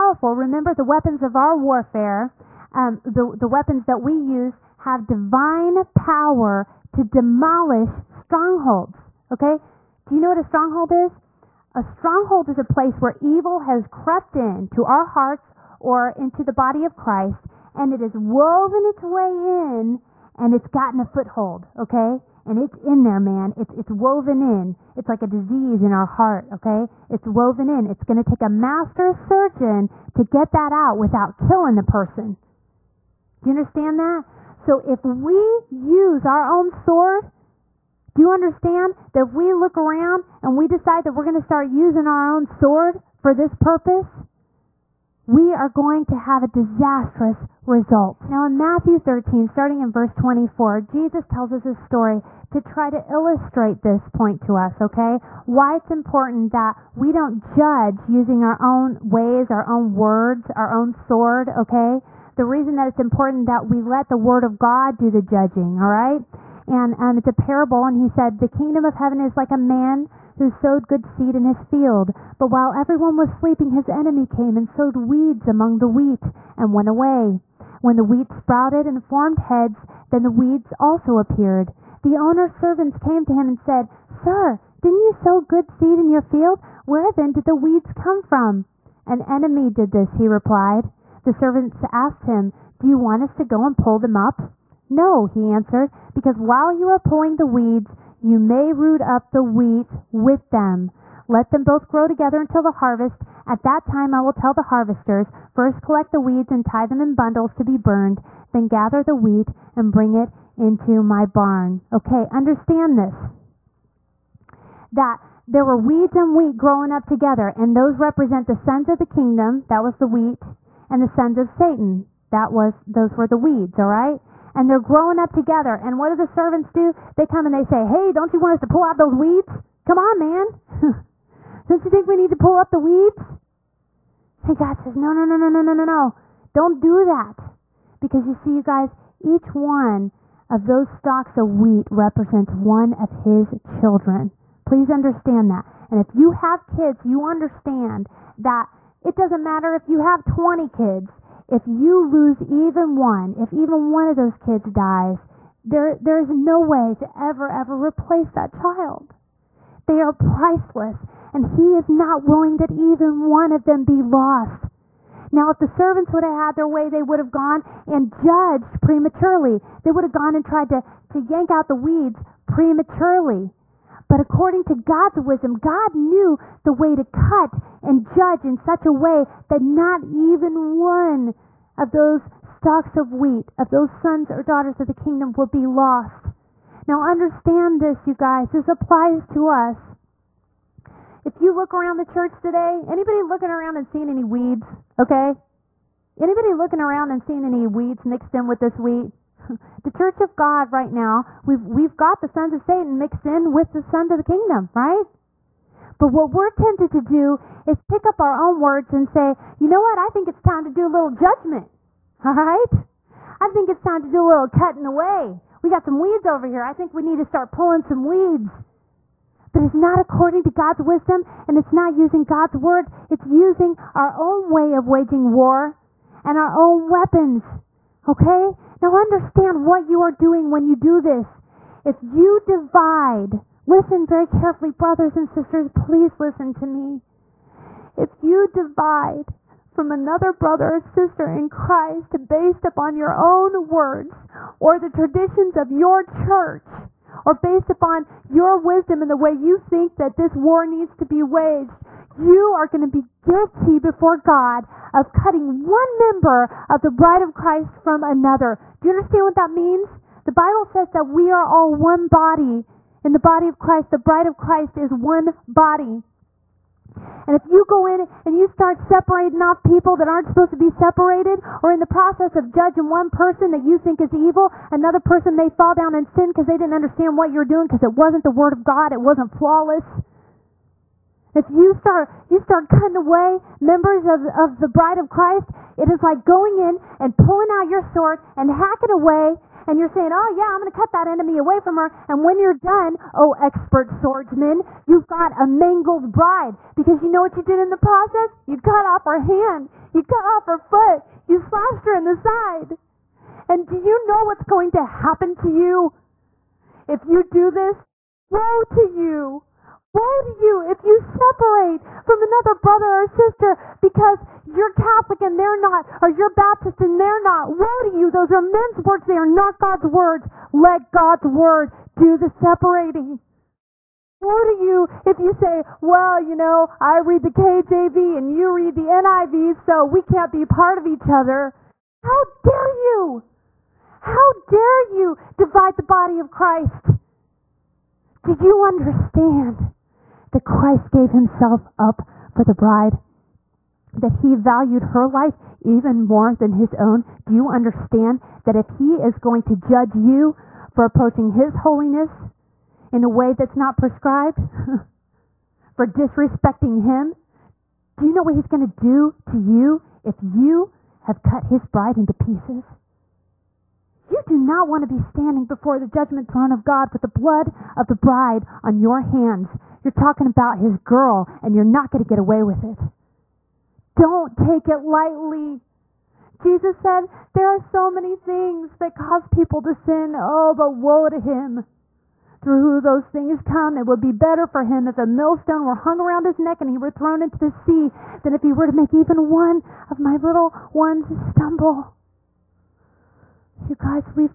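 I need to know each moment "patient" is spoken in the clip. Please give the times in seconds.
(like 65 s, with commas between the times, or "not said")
not said.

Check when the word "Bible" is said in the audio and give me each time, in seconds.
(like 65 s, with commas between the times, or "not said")
260 s.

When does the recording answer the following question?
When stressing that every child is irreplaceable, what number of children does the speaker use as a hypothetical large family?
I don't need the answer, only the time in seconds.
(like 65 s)
150 s.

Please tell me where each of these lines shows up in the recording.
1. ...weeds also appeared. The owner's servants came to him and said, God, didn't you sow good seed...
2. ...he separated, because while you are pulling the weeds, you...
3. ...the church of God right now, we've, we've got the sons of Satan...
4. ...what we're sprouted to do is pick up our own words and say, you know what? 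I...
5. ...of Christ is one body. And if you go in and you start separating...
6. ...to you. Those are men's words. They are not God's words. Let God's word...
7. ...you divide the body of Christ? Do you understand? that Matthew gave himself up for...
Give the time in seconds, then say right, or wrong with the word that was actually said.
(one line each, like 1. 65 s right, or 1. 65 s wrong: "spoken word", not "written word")
1. 80 s wrong: "Sir", not "God"
2. 95 s wrong: "answered", not "separated"
3. 199 s right
4. 206 s wrong: "tempted", not "sprouted"
5. 264 s right
6. 317 s right
7. 334 s wrong: "Christ", not "Matthew".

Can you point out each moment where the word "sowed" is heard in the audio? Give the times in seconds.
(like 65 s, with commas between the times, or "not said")
70 s, 74 s.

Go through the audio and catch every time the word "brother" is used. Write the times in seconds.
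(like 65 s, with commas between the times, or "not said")
234 s, 240 s, 312 s.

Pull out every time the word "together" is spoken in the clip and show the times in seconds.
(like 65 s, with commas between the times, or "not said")
102 s, 117 s, 125 s.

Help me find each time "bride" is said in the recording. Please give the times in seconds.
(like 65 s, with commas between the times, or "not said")
256 s, 263 s, 284 s, 296 s, 342 s, 361 s, 367 s.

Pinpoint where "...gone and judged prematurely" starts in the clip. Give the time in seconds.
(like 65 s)
167 s.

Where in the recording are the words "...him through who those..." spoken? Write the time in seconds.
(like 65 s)
381 s.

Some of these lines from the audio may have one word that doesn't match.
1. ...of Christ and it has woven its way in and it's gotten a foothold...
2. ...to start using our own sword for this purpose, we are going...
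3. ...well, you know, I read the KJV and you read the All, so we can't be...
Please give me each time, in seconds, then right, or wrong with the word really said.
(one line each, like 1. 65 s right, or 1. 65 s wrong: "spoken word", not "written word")
1. 16 s right
2. 41 s right
3. 325 s wrong: "NIV", not "All".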